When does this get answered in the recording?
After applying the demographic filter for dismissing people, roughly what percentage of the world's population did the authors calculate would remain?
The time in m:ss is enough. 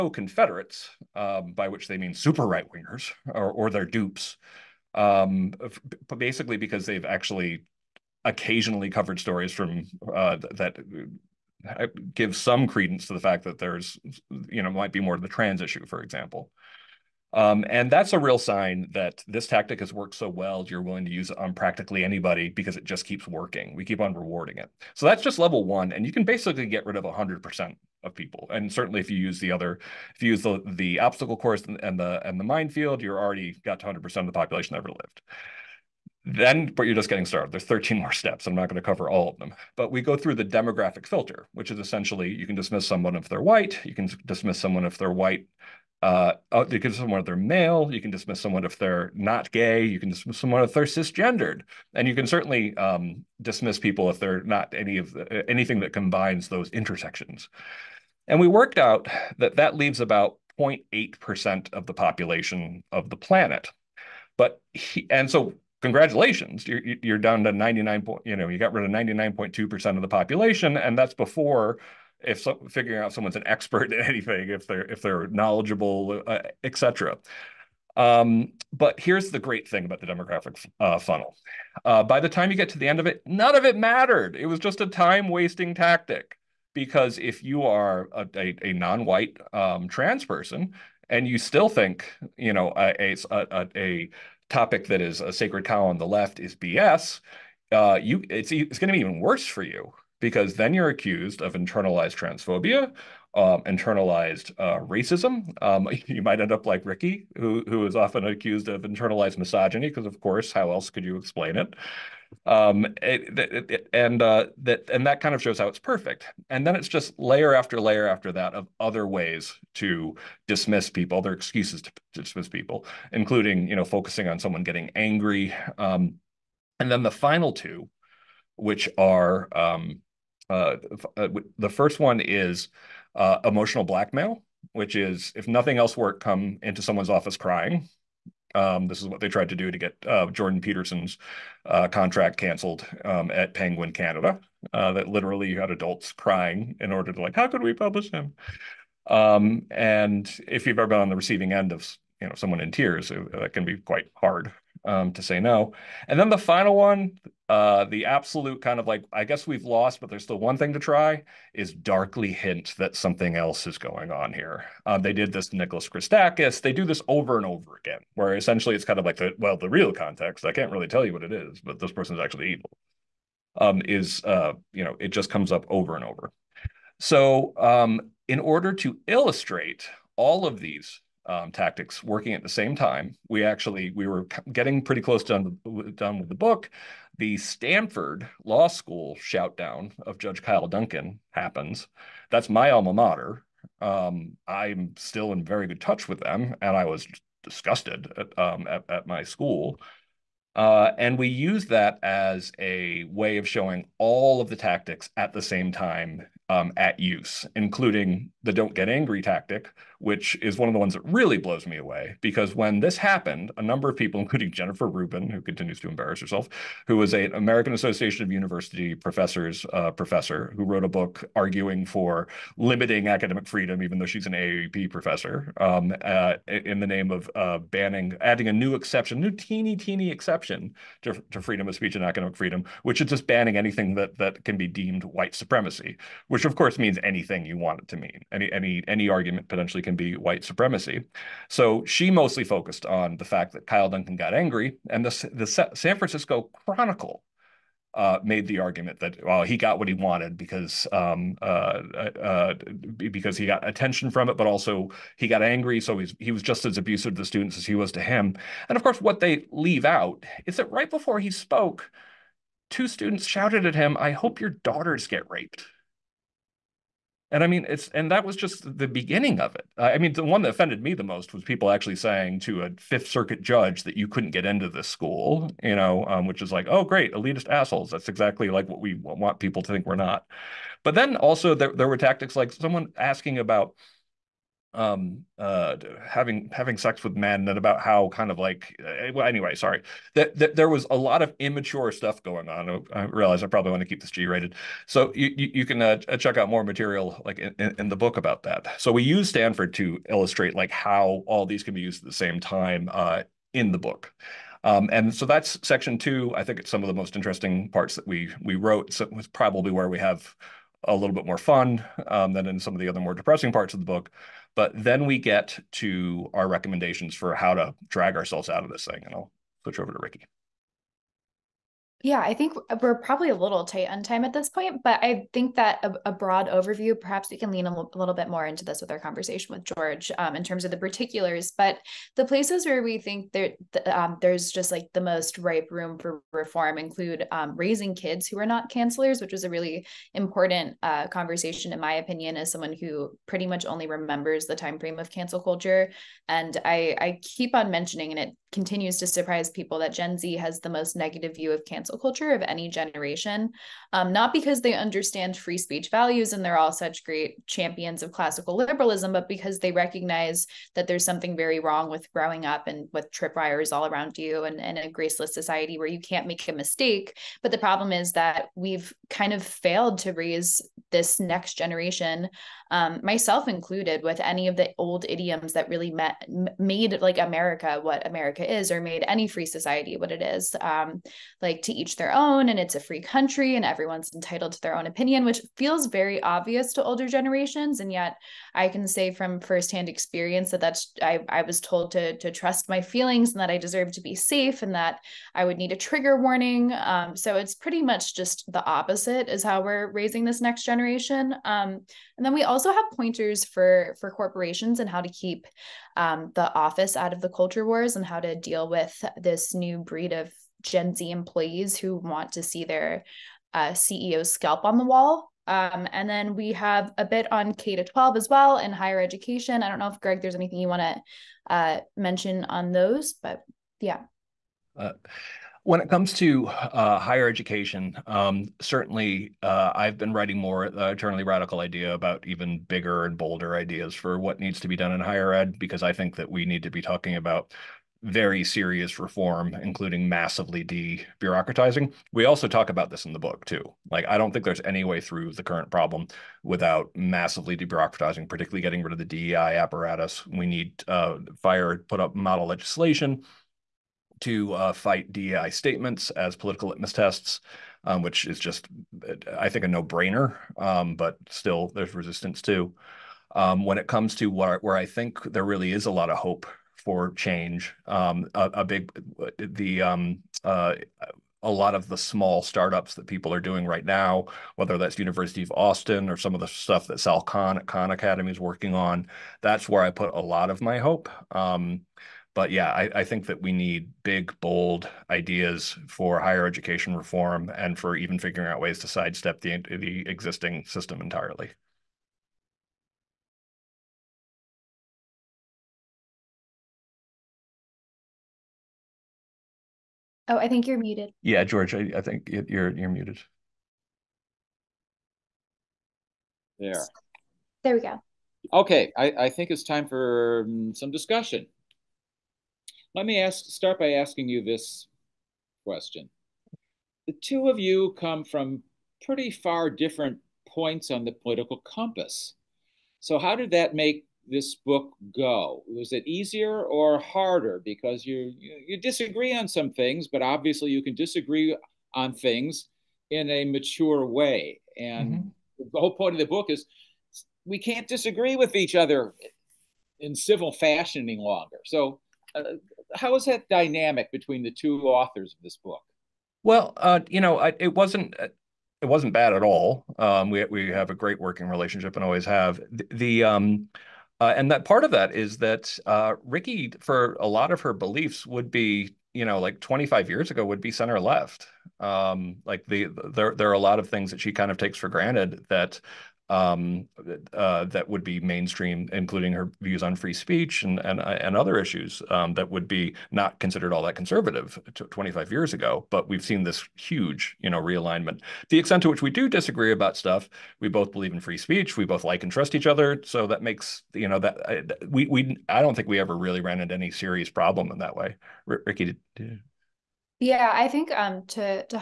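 1:00.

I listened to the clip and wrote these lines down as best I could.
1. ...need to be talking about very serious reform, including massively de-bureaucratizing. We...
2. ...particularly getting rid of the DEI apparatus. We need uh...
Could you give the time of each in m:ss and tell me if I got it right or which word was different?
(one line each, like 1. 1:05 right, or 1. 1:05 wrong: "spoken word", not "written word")
1. 7:16 right
2. 7:28 right.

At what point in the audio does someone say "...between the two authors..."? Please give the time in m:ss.
9:04.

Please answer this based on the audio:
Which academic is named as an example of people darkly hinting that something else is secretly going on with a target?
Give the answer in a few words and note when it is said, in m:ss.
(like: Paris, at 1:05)
Nicholas Christakis, at 2:45.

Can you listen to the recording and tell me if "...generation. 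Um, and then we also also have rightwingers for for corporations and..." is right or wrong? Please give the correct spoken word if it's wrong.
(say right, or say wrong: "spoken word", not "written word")
wrong: "pointers", not "rightwingers".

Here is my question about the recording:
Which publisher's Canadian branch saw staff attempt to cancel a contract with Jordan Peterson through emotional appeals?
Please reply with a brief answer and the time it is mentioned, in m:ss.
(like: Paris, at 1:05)
Penguin Canada, at 2:23.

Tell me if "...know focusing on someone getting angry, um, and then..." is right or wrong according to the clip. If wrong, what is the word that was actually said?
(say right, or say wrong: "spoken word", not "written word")
right.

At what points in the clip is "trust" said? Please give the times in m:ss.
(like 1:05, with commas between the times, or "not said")
6:32, 9:42.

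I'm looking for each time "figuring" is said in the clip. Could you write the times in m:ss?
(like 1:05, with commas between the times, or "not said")
1:12, 8:08.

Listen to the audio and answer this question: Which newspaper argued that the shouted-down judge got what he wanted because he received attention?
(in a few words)
San Francisco Chronicle.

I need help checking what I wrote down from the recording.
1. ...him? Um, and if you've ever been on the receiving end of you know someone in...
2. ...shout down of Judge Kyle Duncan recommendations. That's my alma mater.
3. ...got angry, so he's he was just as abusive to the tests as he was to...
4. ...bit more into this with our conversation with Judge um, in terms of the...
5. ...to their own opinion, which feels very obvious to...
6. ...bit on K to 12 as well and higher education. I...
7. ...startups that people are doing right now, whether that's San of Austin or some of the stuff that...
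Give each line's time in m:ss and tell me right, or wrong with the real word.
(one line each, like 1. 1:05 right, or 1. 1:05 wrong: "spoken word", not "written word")
1. 2:28 right
2. 3:09 wrong: "happens", not "recommendations"
3. 4:15 wrong: "students", not "tests"
4. 5:28 wrong: "George", not "Judge"
5. 6:24 right
6. 6:57 right
7. 7:52 wrong: "University", not "San".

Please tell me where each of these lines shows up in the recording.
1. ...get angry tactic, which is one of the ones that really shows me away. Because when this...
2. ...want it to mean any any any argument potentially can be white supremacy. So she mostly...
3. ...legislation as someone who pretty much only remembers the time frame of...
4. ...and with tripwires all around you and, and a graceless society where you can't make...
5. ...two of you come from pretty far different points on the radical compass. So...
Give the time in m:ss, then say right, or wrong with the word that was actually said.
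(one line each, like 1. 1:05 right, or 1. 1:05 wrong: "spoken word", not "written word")
1. 3:28 wrong: "blows", not "shows"
2. 3:57 right
3. 5:41 wrong: "opinion", not "legislation"
4. 6:02 right
5. 8:37 wrong: "political", not "radical".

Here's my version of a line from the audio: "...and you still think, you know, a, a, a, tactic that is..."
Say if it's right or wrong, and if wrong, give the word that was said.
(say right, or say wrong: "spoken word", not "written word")
wrong: "topic", not "tactic".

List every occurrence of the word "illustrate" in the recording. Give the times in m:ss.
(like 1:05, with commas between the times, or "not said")
2:59, 5:00.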